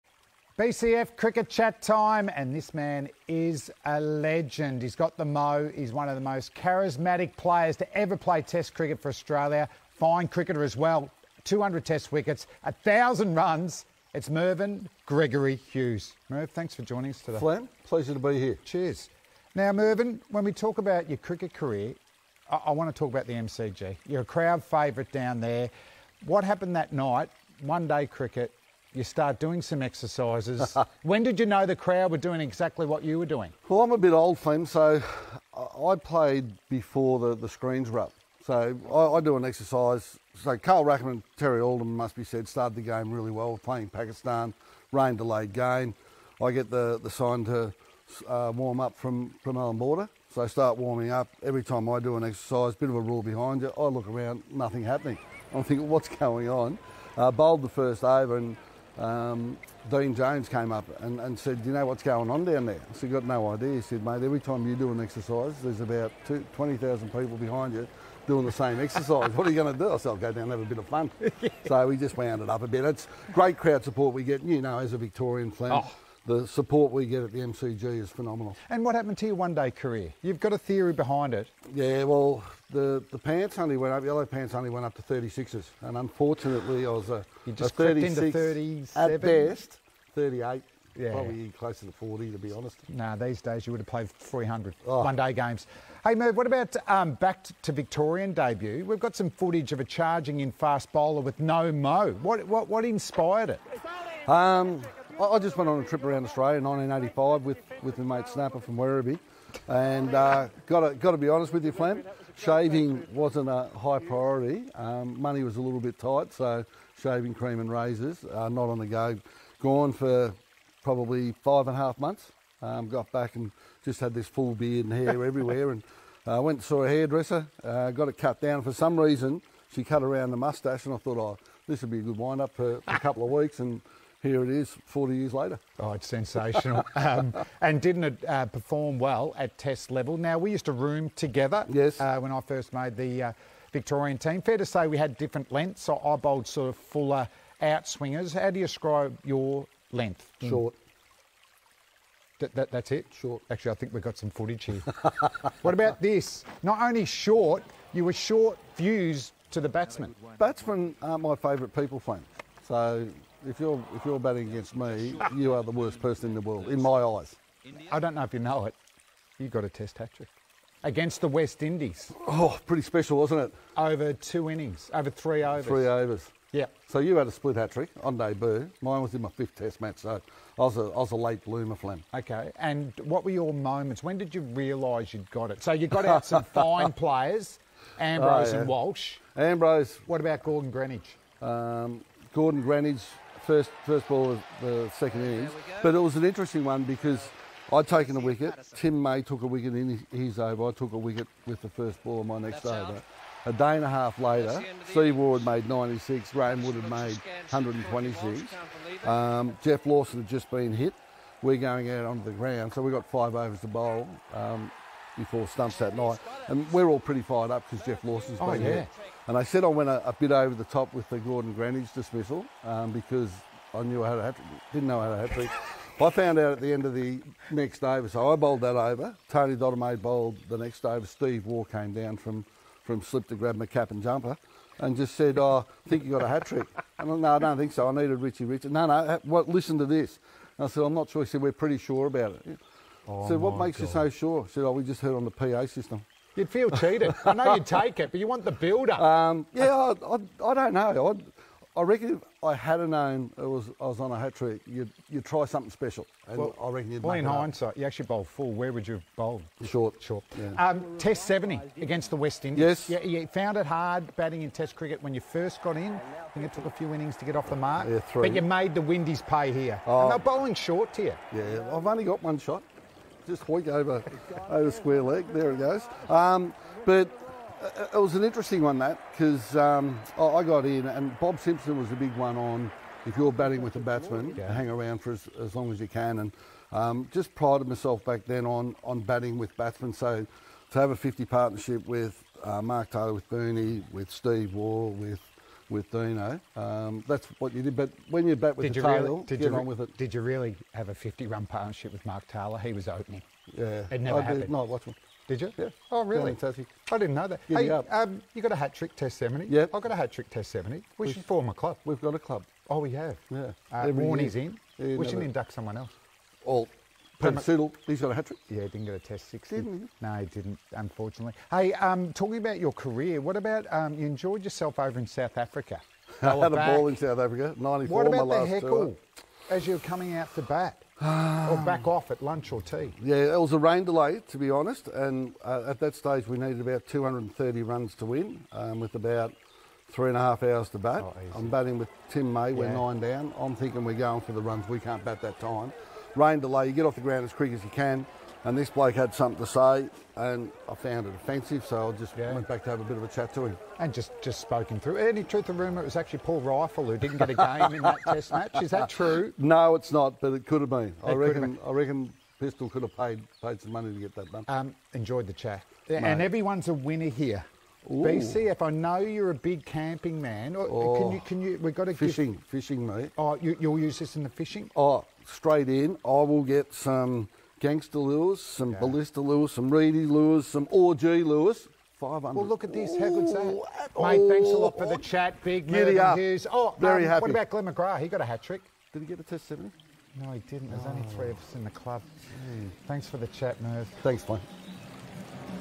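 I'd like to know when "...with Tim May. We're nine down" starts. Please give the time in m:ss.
5:41.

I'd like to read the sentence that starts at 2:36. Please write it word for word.
Not only short, you were short fused to the batsman.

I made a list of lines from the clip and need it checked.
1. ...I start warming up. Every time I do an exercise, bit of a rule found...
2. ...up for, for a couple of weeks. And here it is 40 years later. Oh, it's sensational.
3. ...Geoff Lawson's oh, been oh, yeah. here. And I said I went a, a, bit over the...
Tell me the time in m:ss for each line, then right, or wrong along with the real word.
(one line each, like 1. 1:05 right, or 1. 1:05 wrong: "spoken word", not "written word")
1. 0:50 wrong: "behind", not "found"
2. 2:12 right
3. 3:37 right.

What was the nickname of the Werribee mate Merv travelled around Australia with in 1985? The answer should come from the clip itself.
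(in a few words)
Snapper.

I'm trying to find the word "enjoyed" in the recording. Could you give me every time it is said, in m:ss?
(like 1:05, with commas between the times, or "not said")
5:24, 6:04.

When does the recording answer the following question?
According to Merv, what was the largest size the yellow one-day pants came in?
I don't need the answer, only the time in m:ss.
1:25.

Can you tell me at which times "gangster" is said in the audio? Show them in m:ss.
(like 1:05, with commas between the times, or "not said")
6:17.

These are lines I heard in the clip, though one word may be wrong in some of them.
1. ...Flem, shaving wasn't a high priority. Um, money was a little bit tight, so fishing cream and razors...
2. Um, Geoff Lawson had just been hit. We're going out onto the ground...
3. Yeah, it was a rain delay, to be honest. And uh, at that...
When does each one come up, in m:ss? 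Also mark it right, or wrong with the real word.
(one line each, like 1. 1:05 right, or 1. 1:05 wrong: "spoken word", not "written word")
1. 1:51 wrong: "shaving", not "fishing"
2. 3:29 right
3. 5:33 right.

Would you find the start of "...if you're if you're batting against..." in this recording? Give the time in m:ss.
2:43.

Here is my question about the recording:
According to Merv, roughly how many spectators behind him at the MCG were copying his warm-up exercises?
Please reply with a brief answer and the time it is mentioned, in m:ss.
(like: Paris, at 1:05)
20,000, at 1:06.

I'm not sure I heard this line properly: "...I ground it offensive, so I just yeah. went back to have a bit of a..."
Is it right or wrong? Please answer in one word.
wrong.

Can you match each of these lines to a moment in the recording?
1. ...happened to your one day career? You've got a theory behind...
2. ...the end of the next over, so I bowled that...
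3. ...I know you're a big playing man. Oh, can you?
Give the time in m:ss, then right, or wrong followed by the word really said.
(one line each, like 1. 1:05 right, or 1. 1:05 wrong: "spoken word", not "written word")
1. 1:18 right
2. 3:46 right
3. 6:08 wrong: "camping", not "playing".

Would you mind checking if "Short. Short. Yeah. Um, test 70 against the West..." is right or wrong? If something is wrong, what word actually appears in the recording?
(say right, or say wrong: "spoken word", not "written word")
right.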